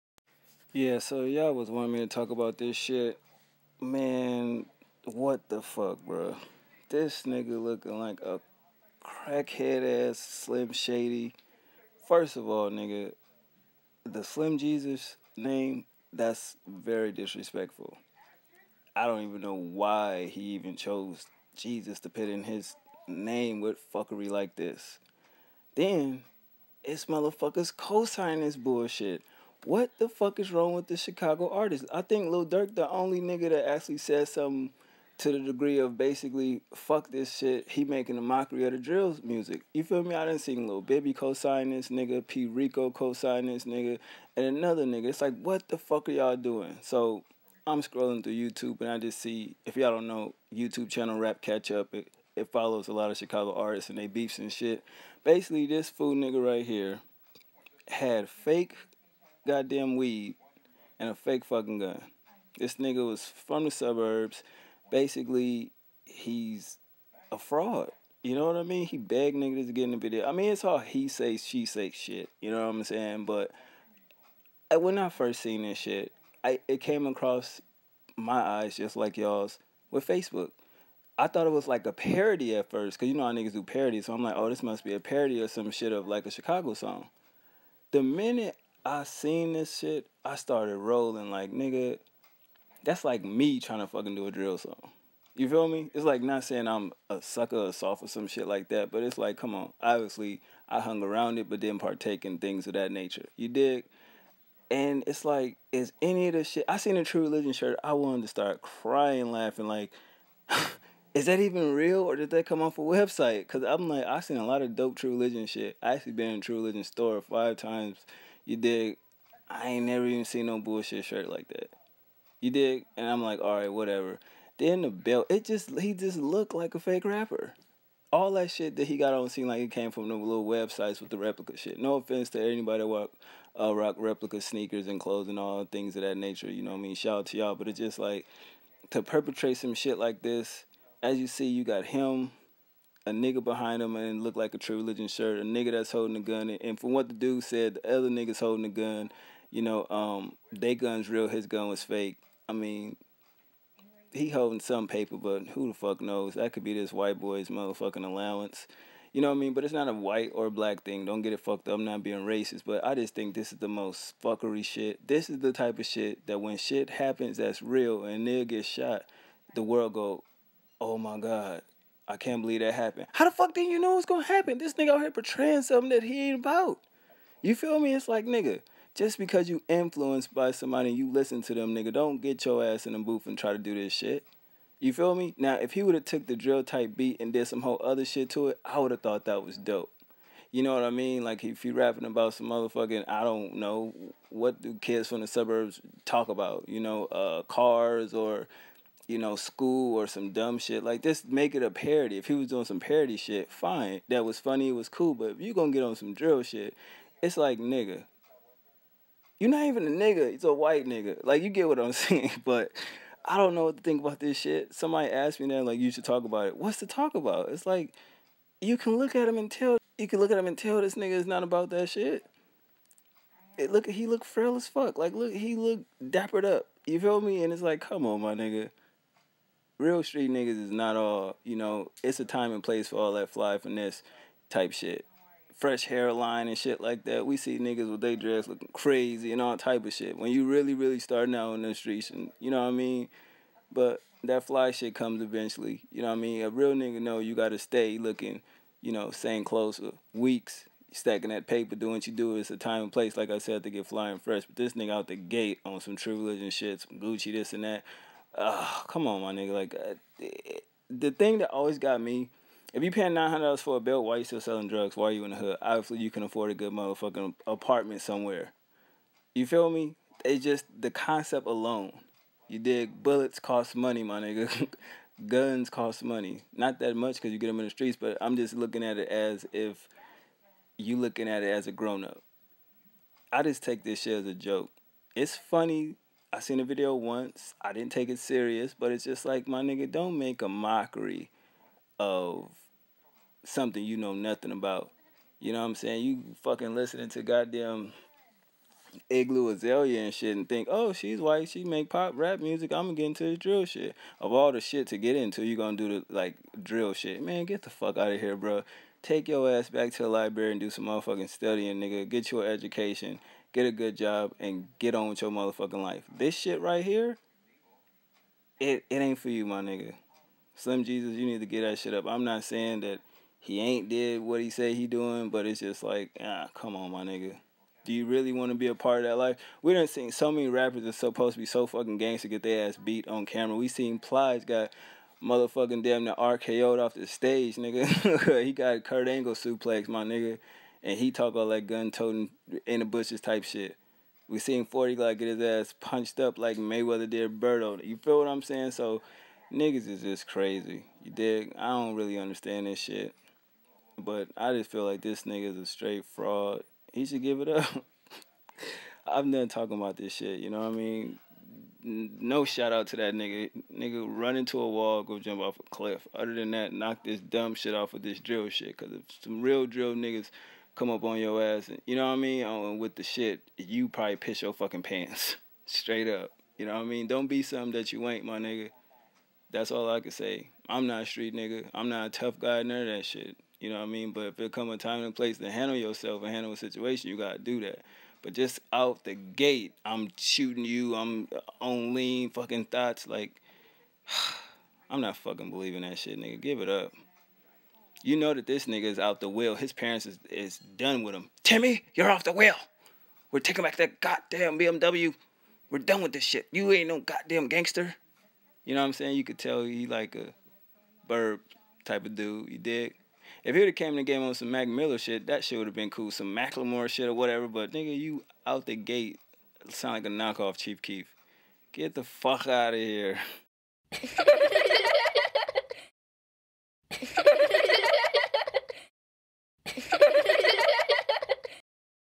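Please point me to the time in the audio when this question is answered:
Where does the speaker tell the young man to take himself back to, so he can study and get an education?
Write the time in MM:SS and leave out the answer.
05:10.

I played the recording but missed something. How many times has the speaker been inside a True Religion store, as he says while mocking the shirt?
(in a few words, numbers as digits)
5.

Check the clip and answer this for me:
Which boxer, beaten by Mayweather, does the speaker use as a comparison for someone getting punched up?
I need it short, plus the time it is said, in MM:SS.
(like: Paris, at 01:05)
Berto, at 05:47.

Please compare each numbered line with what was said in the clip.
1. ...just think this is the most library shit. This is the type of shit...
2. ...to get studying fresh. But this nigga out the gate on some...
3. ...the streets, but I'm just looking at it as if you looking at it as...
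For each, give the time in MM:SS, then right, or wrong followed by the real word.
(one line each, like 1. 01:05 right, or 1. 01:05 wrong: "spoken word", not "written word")
1. 02:42 wrong: "fuckery", not "library"
2. 04:13 wrong: "flying", not "studying"
3. 04:37 right.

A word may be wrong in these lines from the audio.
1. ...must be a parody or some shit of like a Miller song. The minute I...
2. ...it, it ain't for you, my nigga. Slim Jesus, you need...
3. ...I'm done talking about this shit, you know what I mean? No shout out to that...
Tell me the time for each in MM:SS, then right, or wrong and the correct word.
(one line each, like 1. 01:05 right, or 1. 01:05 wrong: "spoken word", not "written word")
1. 01:24 wrong: "Chicago", not "Miller"
2. 05:18 right
3. 05:59 right.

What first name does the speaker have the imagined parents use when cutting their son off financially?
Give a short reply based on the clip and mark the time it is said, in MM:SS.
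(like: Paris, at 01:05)
Timmy, at 06:41.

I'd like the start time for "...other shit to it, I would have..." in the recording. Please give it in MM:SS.
03:07.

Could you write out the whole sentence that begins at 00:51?
It, it follows a lot of Chicago artists and they beefs and shit.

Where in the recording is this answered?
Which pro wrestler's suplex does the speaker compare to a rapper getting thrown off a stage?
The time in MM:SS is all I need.
05:38.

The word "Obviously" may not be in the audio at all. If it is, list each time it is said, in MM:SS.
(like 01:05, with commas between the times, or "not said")
01:39, 04:25.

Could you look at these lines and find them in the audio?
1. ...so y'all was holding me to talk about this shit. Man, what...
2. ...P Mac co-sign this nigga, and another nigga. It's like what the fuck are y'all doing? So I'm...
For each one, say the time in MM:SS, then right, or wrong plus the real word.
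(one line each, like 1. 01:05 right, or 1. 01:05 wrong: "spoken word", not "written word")
1. 00:00 wrong: "wanting", not "holding"
2. 00:42 wrong: "Rico", not "Mac".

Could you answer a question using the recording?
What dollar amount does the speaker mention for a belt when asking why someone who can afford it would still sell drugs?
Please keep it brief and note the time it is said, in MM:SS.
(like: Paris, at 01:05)
$900, at 04:23.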